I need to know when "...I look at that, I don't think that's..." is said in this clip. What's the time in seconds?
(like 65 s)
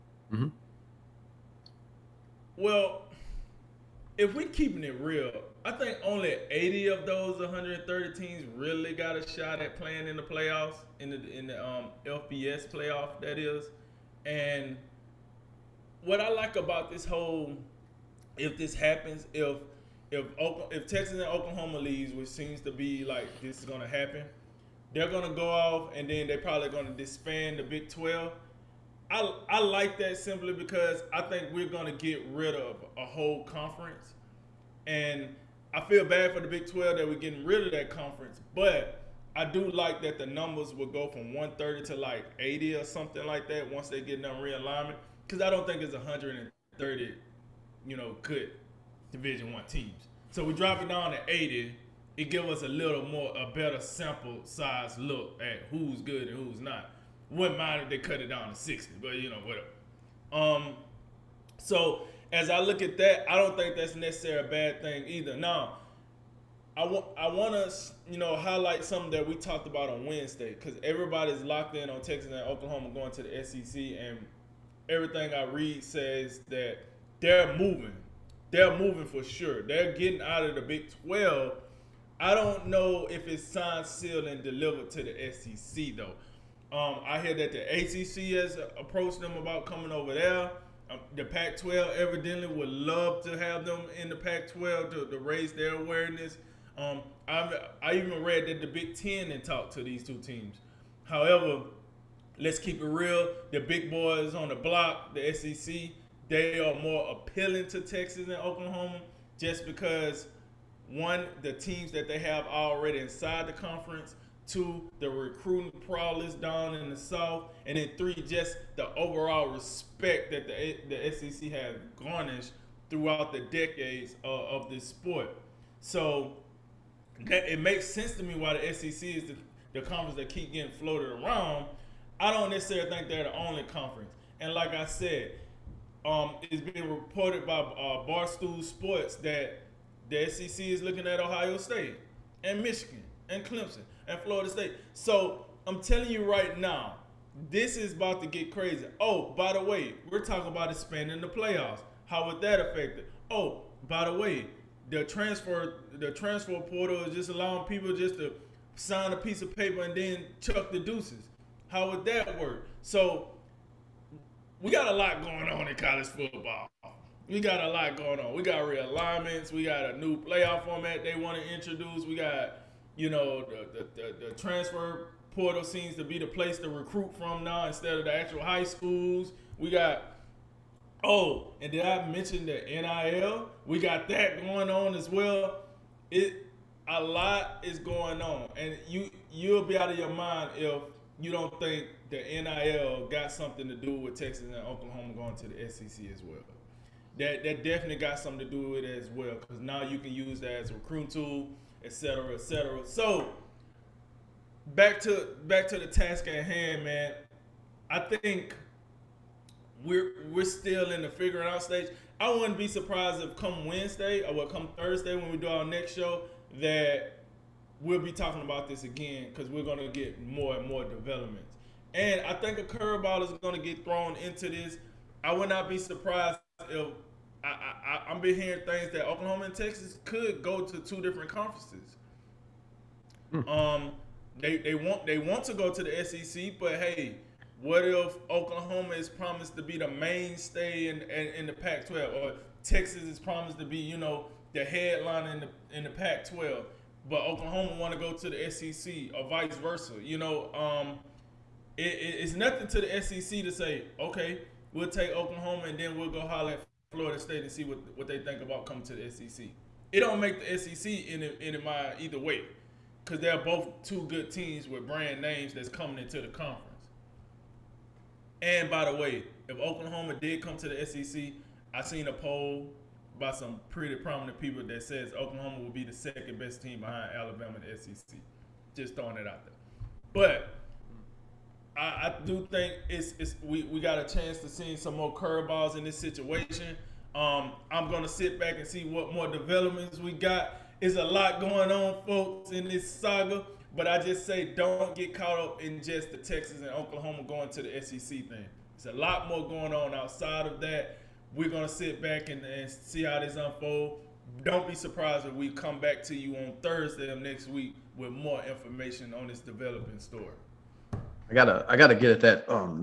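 62 s.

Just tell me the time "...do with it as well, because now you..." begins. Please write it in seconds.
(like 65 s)
198 s.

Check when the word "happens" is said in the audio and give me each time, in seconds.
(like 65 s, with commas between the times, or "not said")
18 s, 23 s.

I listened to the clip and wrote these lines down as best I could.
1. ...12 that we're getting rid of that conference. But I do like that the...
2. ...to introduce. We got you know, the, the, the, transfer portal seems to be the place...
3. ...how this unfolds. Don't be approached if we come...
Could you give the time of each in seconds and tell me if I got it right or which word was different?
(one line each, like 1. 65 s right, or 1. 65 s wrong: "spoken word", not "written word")
1. 36 s right
2. 171 s right
3. 303 s wrong: "surprised", not "approached".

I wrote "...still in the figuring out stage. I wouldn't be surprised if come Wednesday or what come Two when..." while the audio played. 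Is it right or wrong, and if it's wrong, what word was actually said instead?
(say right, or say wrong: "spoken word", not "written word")
wrong: "Thursday", not "Two".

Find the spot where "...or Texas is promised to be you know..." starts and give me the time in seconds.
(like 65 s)
242 s.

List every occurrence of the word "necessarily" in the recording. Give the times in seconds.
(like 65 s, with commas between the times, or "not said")
63 s, 132 s.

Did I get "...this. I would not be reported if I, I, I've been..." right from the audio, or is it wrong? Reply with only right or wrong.
wrong.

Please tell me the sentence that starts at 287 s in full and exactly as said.
Um, I'm gonna sit back and see what more developments we got.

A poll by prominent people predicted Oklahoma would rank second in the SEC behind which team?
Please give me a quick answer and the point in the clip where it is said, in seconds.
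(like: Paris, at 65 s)
Alabama, at 277 s.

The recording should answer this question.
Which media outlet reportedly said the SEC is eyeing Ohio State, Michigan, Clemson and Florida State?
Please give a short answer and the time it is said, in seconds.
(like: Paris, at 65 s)
Barstool Sports, at 138 s.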